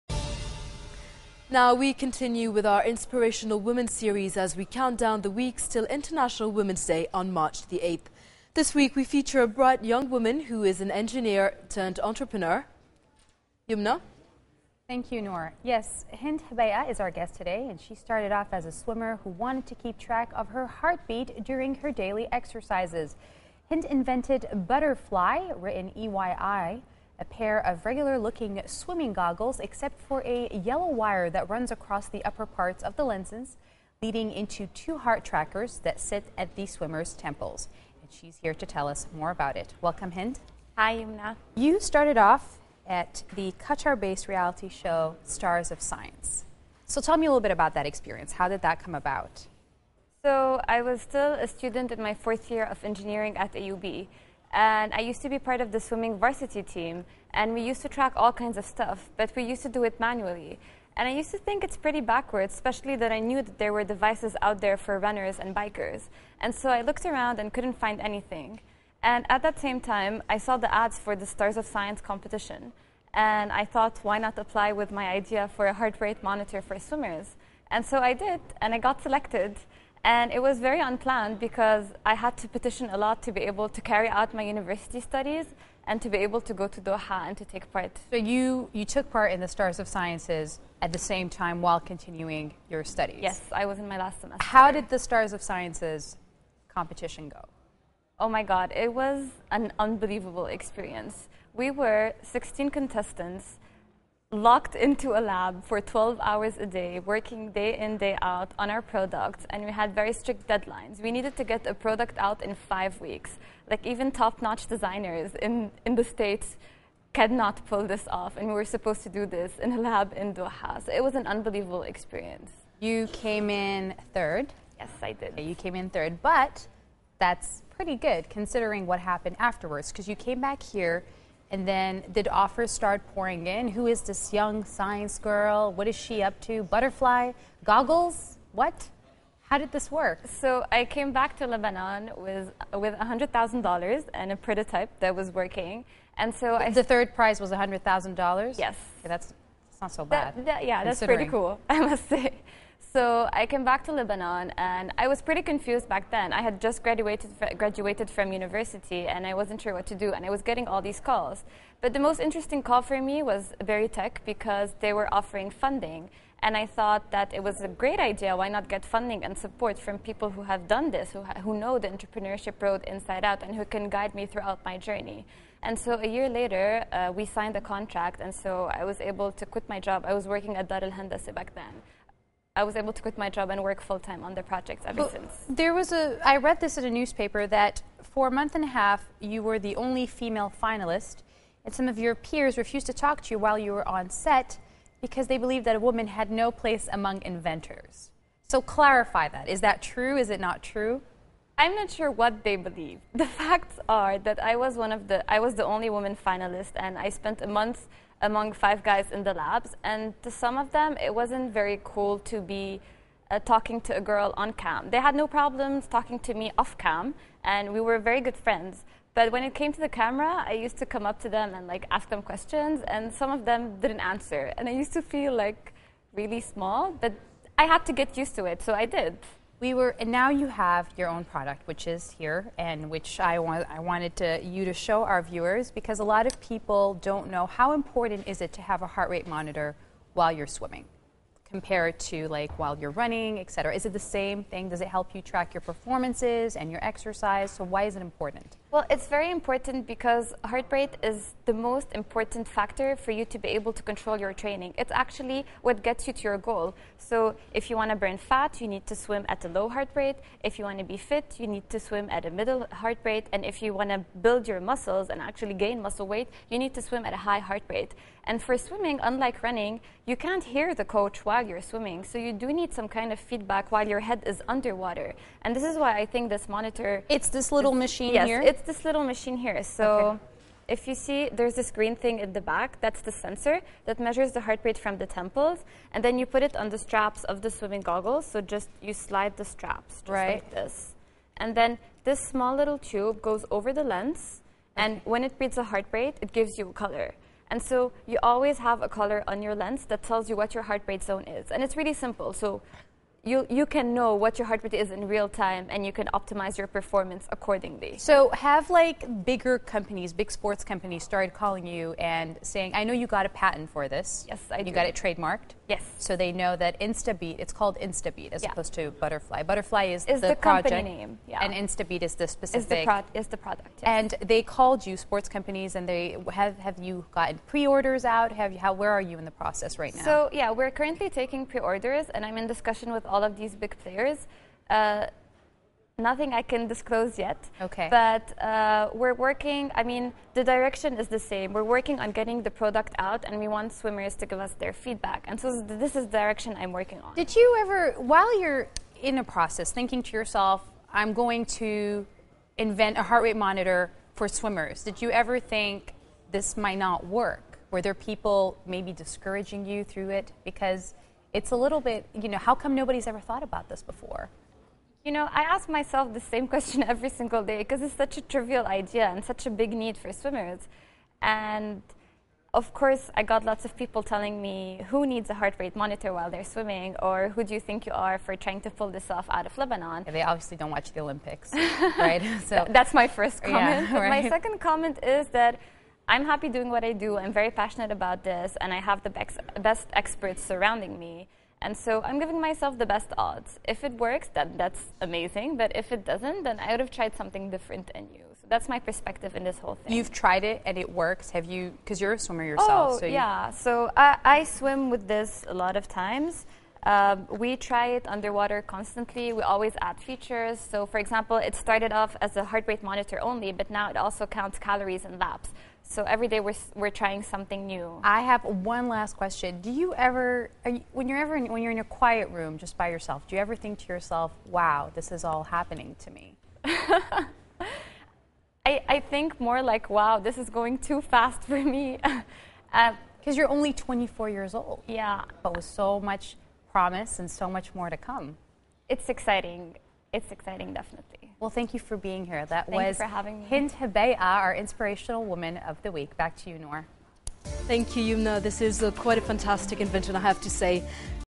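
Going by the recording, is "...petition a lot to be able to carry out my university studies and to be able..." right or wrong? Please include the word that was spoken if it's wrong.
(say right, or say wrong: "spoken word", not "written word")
right.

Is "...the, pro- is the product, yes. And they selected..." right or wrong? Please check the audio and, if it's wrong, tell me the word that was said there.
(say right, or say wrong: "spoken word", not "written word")
wrong: "called", not "selected".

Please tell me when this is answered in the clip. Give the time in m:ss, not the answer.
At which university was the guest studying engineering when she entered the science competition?
0:53.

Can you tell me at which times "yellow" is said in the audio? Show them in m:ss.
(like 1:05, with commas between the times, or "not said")
0:30.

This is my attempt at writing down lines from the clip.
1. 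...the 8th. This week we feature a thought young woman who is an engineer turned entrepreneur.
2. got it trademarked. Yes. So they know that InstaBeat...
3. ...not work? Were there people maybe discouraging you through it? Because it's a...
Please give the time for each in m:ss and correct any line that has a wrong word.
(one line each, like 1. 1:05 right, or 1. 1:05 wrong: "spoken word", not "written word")
1. 0:07 wrong: "bright", not "thought"
2. 5:14 right
3. 5:56 right.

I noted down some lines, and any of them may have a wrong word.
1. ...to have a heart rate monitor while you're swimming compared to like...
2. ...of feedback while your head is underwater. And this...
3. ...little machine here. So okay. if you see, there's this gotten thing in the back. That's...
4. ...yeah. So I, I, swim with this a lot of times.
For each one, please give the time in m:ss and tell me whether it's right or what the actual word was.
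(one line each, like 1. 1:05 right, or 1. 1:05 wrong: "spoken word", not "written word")
1. 3:58 right
2. 4:33 right
3. 4:38 wrong: "green", not "gotten"
4. 6:43 right.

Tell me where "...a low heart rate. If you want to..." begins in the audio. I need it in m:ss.
4:19.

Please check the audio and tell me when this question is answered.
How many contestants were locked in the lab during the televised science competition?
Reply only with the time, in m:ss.
1:42.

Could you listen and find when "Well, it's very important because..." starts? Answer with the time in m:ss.
4:08.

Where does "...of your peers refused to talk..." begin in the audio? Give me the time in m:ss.
3:11.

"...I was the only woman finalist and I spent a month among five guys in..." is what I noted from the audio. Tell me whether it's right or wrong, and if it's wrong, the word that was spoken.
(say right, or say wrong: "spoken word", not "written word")
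right.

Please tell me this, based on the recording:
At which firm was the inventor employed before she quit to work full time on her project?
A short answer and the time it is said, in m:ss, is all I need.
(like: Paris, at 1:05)
Dar al Handasah, at 3:00.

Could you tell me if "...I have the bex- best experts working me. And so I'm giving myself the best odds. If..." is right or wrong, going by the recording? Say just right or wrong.
wrong.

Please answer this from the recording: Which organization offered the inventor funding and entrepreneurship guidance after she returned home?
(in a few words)
Berytech.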